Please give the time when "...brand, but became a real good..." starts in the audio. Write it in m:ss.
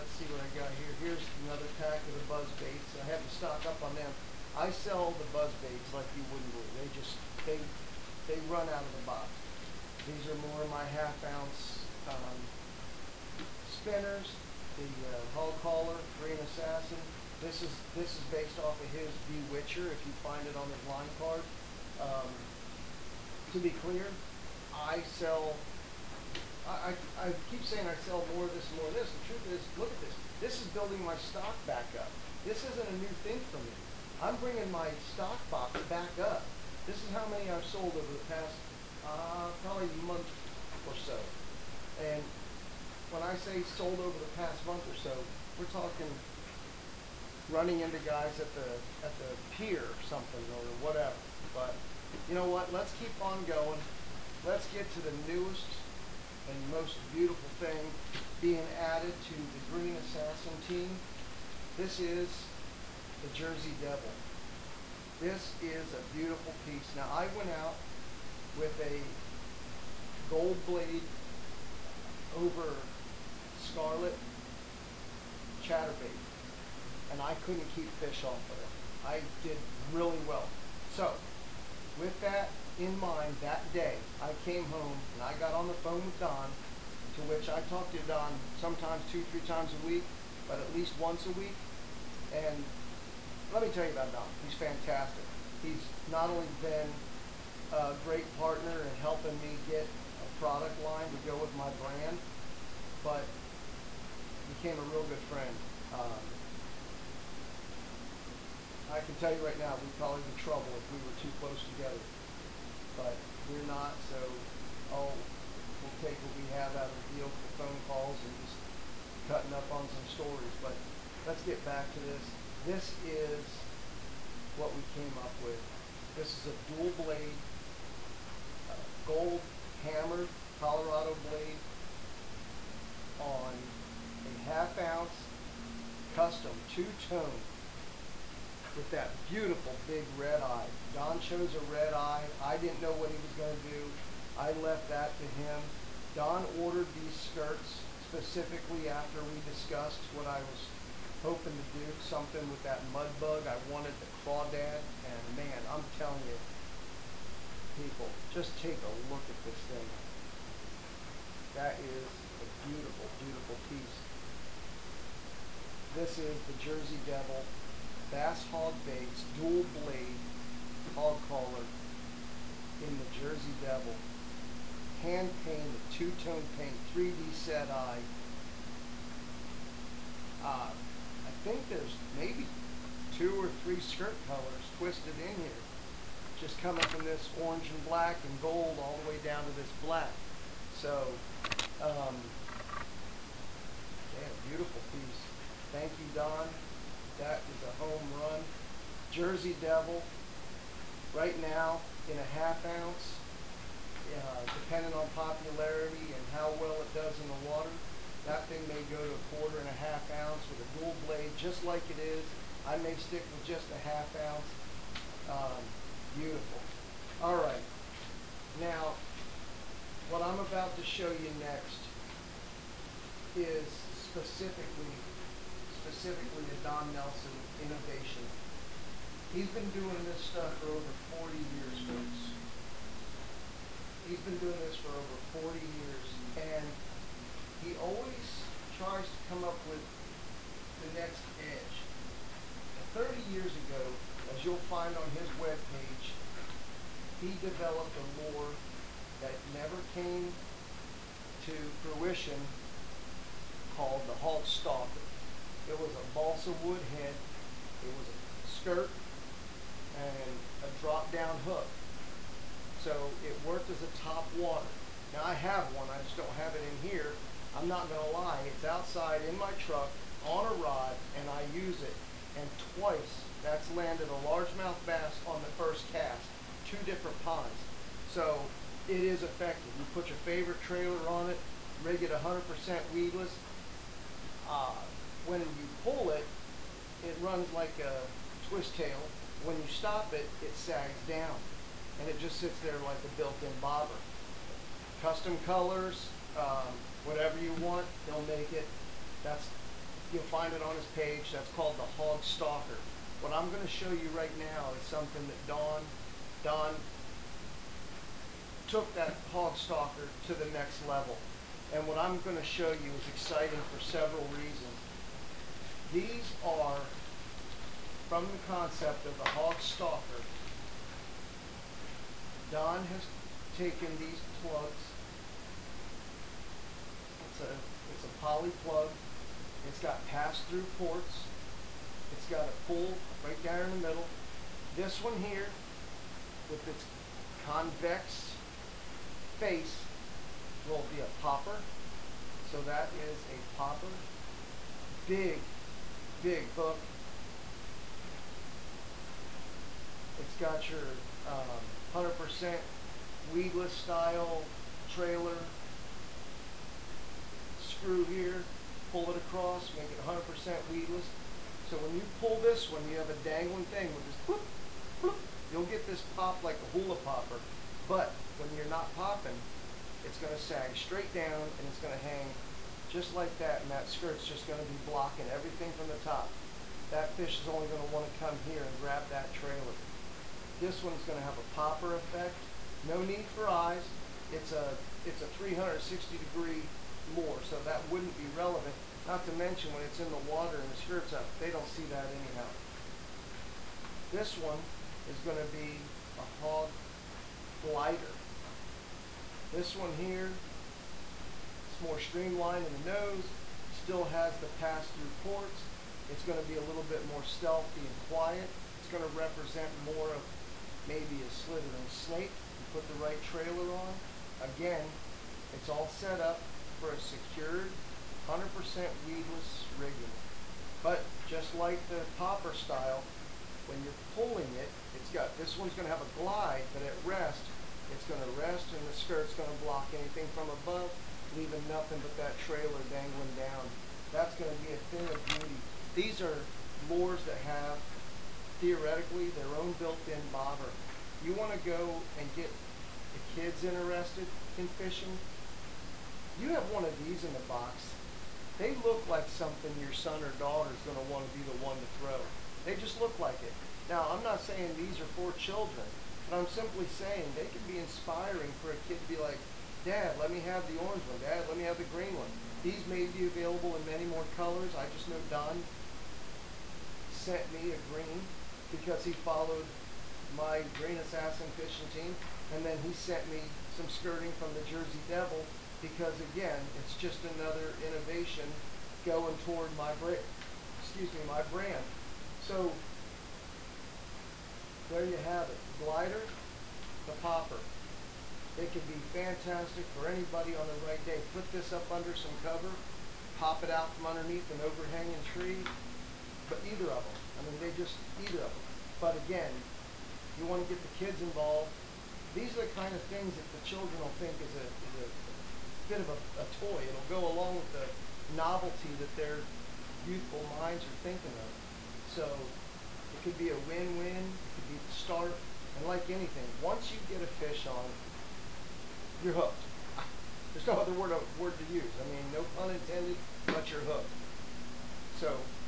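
1:41.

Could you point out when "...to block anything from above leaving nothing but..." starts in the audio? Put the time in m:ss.
7:09.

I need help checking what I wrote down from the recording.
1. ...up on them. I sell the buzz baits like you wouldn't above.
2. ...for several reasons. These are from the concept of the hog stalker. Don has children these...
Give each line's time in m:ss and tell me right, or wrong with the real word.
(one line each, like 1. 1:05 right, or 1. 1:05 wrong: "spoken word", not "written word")
1. 0:03 wrong: "believe", not "above"
2. 5:13 wrong: "taken", not "children".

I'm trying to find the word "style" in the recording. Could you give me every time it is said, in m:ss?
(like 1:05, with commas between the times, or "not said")
5:53, 7:02.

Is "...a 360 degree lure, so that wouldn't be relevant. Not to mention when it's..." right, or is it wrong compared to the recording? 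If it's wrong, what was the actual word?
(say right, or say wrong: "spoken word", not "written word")
right.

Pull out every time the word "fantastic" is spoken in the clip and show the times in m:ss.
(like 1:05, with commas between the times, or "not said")
1:34, 8:09.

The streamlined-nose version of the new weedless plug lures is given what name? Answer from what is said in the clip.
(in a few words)
Hog glider.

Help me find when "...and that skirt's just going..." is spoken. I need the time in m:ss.
6:13.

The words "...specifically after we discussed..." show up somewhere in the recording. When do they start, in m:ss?
2:28.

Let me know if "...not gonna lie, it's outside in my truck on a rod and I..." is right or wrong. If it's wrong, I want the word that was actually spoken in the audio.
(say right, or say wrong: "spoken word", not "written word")
right.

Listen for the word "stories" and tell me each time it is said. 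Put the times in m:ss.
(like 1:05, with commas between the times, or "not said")
2:00.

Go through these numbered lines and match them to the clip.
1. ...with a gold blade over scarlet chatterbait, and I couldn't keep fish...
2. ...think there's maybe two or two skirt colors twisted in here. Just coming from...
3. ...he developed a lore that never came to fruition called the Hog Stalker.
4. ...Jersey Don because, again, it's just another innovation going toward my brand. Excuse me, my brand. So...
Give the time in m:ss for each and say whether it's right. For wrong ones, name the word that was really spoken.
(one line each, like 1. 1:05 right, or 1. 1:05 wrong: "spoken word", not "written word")
1. 1:08 right
2. 3:01 wrong: "three", not "two"
3. 4:07 right
4. 7:54 wrong: "Devil", not "Don".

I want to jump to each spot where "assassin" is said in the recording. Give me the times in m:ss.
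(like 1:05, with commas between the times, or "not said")
0:16, 0:59, 7:50.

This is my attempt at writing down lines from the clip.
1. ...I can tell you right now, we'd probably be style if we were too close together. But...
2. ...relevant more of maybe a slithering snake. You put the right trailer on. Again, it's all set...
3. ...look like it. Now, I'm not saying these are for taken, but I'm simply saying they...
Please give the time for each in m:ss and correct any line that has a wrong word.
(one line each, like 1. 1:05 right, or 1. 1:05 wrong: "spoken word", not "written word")
1. 1:48 wrong: "trouble", not "style"
2. 6:49 wrong: "represent", not "relevant"
3. 7:33 wrong: "children", not "taken".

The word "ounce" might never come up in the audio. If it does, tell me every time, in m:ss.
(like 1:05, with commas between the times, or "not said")
0:11, 2:14, 3:22, 3:30, 3:34.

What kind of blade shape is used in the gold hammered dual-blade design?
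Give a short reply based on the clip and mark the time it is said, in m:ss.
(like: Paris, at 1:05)
Colorado, at 2:09.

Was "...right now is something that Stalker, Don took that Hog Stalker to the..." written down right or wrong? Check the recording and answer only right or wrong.
wrong.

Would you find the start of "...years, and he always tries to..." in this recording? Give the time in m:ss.
3:55.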